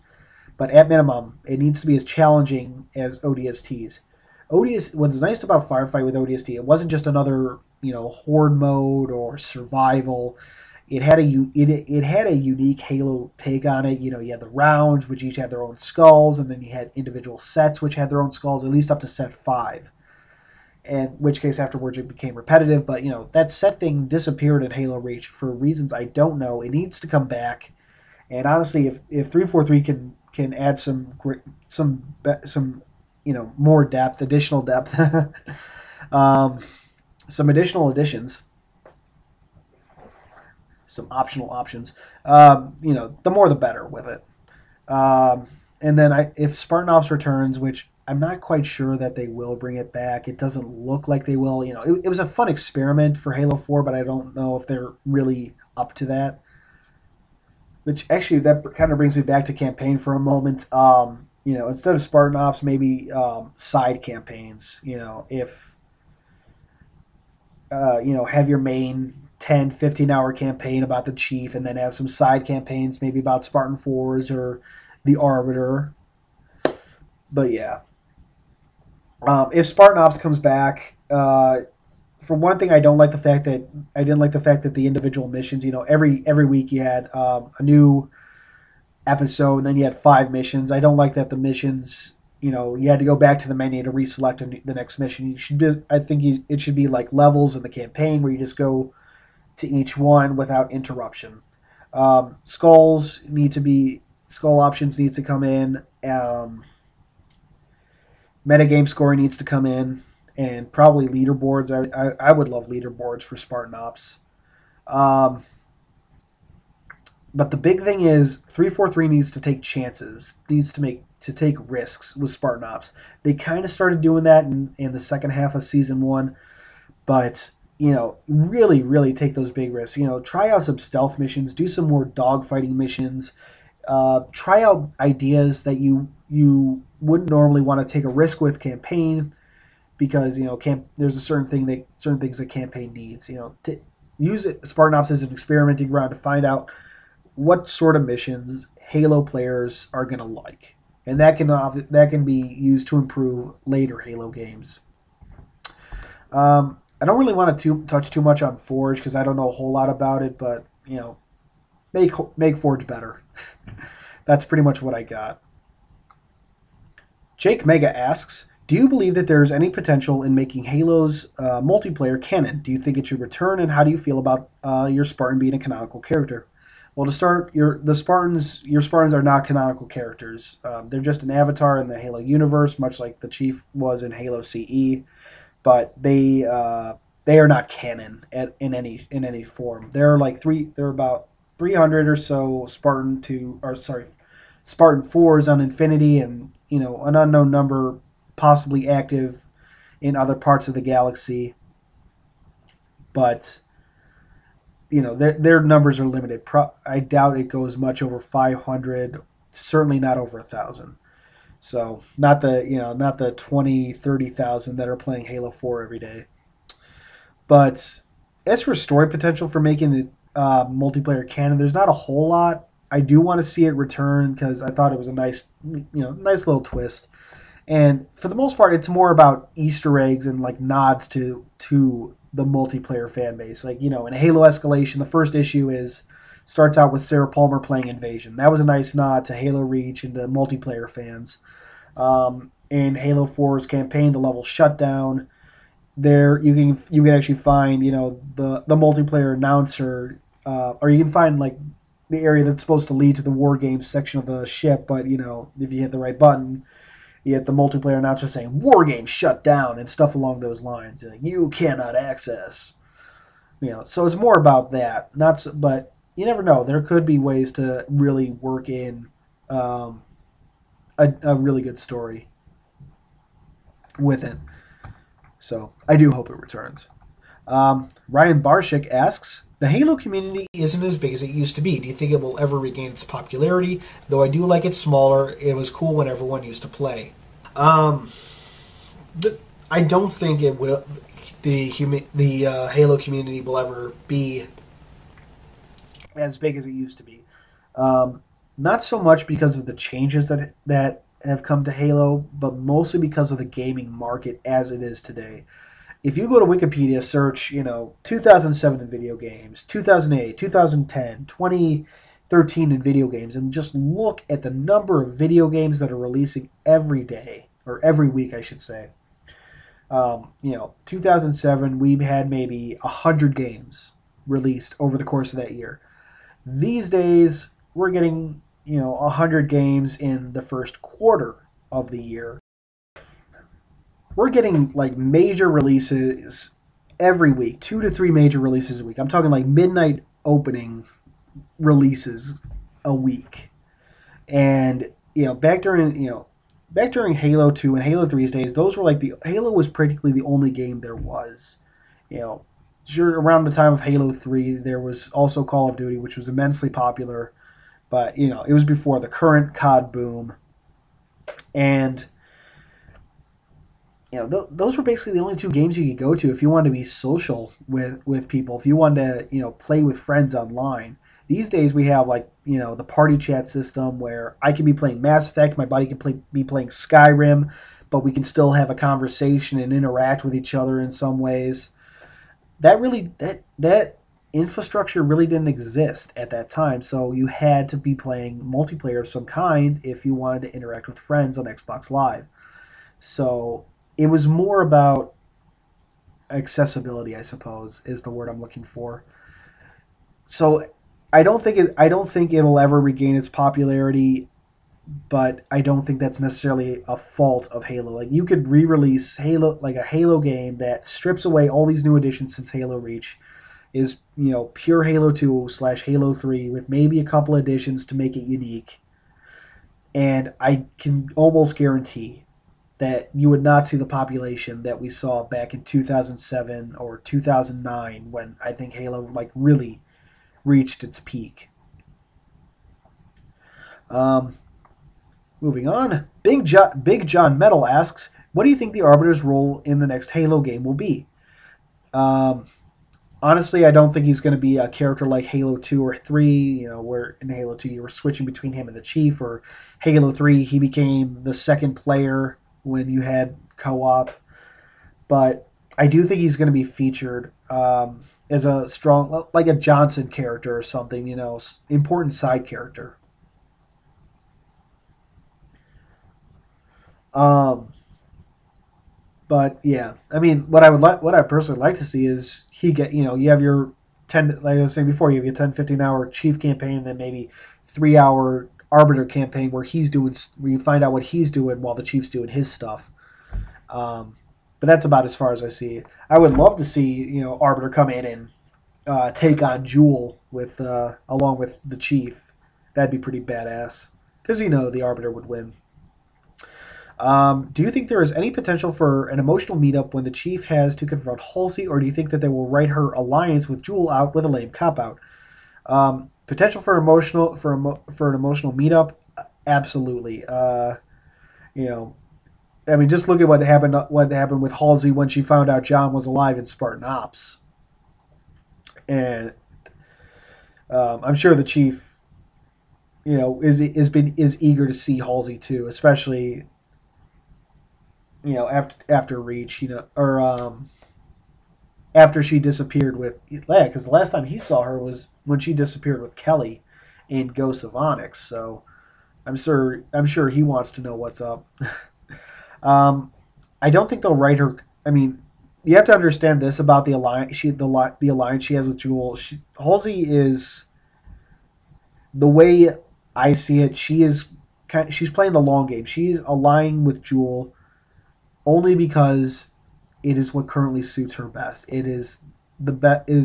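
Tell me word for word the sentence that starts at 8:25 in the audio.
Um, potential for emotional for emo, for an emotional meetup, absolutely.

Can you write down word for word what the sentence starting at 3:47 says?
And for the most part, it's more about Easter eggs and like nods to to the multiplayer fan base.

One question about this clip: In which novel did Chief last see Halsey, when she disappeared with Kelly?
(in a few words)
Ghost of Onyx.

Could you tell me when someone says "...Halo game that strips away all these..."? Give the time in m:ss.
6:49.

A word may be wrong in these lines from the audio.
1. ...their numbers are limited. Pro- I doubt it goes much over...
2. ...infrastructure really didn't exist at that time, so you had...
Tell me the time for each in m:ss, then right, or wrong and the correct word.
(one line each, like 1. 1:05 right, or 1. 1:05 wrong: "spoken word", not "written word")
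1. 3:25 right
2. 6:24 right.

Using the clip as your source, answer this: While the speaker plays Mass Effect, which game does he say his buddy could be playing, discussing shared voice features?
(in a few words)
Skyrim.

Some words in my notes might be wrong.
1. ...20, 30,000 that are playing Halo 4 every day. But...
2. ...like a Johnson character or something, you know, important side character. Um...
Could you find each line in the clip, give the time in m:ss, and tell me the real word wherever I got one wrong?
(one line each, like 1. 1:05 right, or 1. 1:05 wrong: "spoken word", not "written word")
1. 3:33 right
2. 7:39 right.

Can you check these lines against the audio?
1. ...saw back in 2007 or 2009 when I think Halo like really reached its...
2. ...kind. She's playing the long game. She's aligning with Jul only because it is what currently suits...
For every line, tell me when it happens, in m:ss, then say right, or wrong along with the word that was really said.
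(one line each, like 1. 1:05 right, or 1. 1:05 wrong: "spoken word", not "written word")
1. 7:04 right
2. 9:14 right.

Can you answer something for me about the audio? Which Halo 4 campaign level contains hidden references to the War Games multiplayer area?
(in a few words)
Shutdown.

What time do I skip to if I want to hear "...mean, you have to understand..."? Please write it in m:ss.
9:04.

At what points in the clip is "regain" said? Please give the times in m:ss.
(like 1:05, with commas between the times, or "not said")
4:42, 6:42.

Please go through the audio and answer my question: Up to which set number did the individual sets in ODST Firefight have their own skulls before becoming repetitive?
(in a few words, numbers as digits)
5.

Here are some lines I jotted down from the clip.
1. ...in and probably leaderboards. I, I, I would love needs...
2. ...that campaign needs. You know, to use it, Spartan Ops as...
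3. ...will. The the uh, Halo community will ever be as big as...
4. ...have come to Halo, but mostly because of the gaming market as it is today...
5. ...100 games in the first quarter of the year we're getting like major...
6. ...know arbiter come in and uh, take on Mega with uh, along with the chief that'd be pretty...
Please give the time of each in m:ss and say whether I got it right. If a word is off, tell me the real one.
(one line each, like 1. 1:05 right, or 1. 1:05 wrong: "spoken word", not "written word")
1. 1:49 wrong: "leaderboards", not "needs"
2. 2:22 right
3. 4:50 right
4. 5:01 right
5. 5:28 right
6. 8:07 wrong: "Jul", not "Mega".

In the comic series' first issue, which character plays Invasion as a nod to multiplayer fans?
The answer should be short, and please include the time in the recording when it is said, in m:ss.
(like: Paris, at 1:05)
Sarah Palmer, at 3:57.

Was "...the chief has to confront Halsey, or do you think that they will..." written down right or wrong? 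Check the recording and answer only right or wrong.
right.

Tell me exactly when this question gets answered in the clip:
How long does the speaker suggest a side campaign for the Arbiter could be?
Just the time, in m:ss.
7:57.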